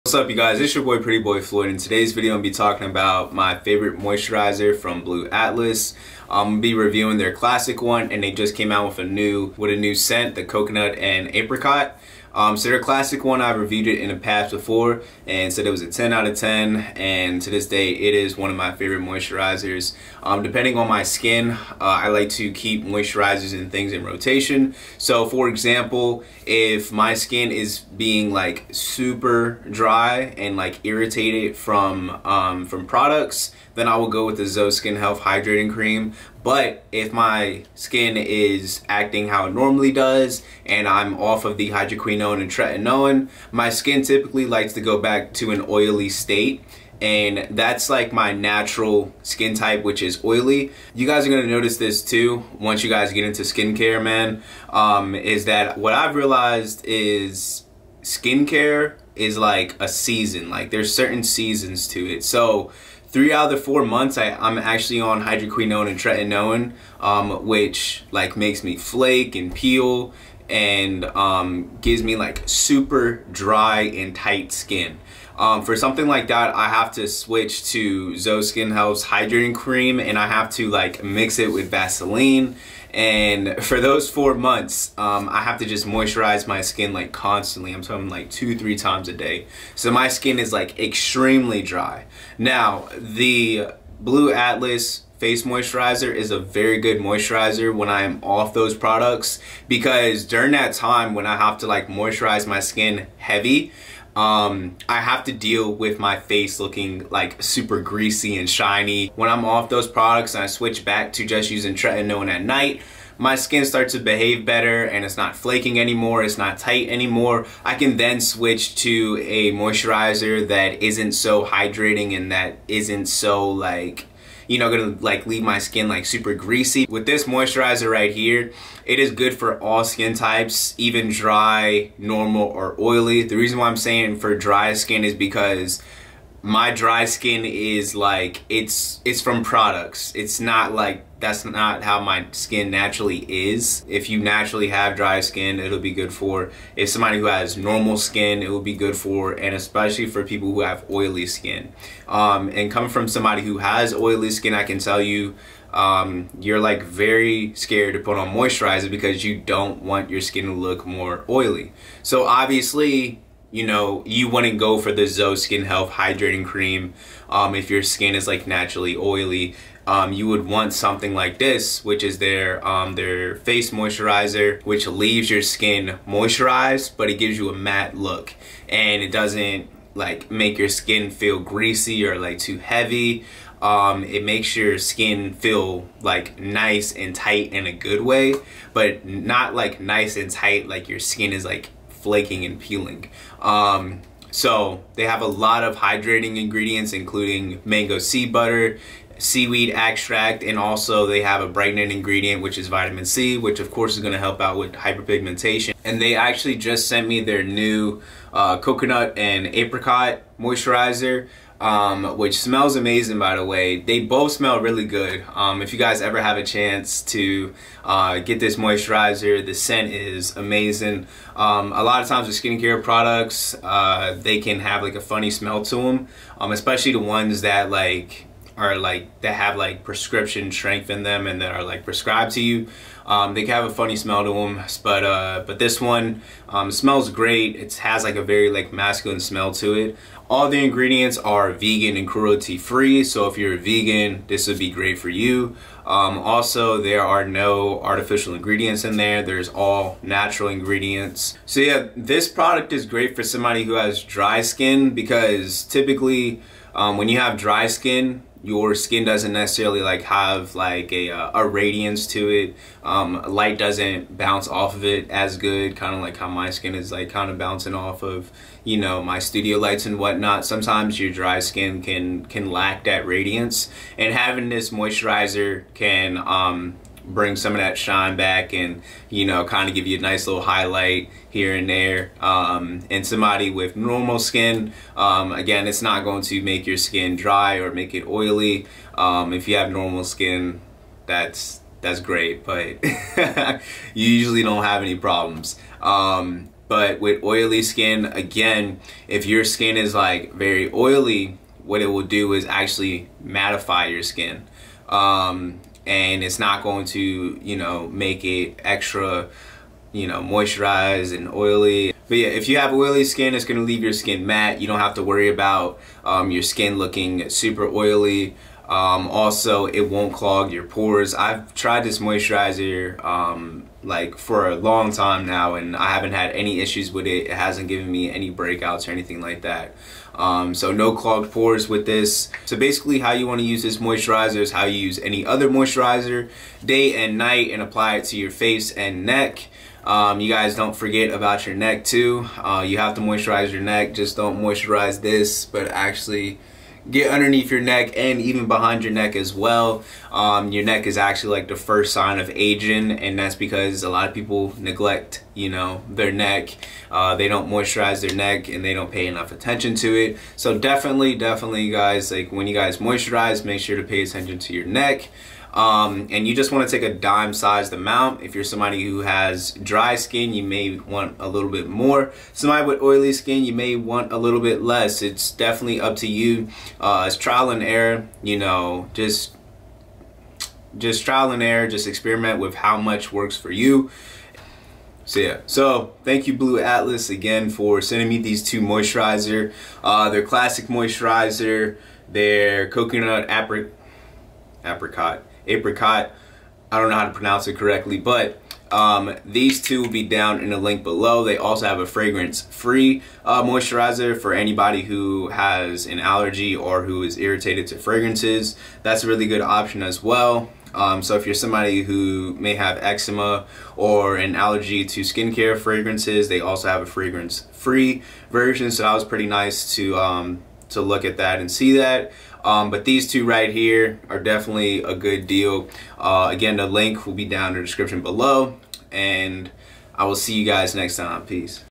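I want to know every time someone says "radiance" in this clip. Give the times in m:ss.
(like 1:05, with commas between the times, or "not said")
4:21, 4:33.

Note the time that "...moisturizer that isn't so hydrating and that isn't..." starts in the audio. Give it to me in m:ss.
1:59.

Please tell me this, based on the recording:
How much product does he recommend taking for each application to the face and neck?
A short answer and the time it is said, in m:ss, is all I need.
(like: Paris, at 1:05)
dime sized amount, at 6:06.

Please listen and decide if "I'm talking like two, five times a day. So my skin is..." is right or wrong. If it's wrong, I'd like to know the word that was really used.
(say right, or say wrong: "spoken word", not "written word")
wrong: "three", not "five".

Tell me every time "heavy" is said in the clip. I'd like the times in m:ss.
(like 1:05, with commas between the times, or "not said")
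1:43, 3:02.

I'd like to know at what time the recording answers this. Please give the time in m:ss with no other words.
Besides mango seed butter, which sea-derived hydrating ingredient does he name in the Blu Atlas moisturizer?
3:19.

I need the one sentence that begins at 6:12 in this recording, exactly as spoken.
Somebody with oily skin, you may want a little bit less.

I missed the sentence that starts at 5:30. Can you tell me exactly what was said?
Um, so no clogged pores with this.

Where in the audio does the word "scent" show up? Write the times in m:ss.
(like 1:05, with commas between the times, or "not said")
0:09, 3:39.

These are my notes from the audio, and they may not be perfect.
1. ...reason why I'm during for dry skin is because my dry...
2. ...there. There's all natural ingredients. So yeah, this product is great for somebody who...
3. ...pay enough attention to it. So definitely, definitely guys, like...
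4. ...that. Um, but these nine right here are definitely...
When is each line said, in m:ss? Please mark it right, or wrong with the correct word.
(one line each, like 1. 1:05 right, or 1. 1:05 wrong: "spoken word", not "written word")
1. 2:13 wrong: "saying", not "during"
2. 4:08 right
3. 5:58 right
4. 7:01 wrong: "two", not "nine".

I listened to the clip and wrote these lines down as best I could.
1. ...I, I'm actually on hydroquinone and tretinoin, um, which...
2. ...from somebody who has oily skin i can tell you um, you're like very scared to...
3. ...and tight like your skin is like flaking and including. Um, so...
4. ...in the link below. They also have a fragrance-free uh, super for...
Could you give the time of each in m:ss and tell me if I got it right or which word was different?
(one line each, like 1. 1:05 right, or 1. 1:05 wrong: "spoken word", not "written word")
1. 1:04 right
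2. 2:32 right
3. 3:10 wrong: "peeling", not "including"
4. 6:40 wrong: "moisturizer", not "super".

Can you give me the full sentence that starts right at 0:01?
In today's video, I'm gonna be talking about my favorite moisturizer from Blu Atlas.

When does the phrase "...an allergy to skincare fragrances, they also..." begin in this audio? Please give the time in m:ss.
6:54.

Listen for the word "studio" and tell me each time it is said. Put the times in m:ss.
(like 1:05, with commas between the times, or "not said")
4:29.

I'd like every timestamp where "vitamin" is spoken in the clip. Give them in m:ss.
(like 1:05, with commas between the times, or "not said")
3:22.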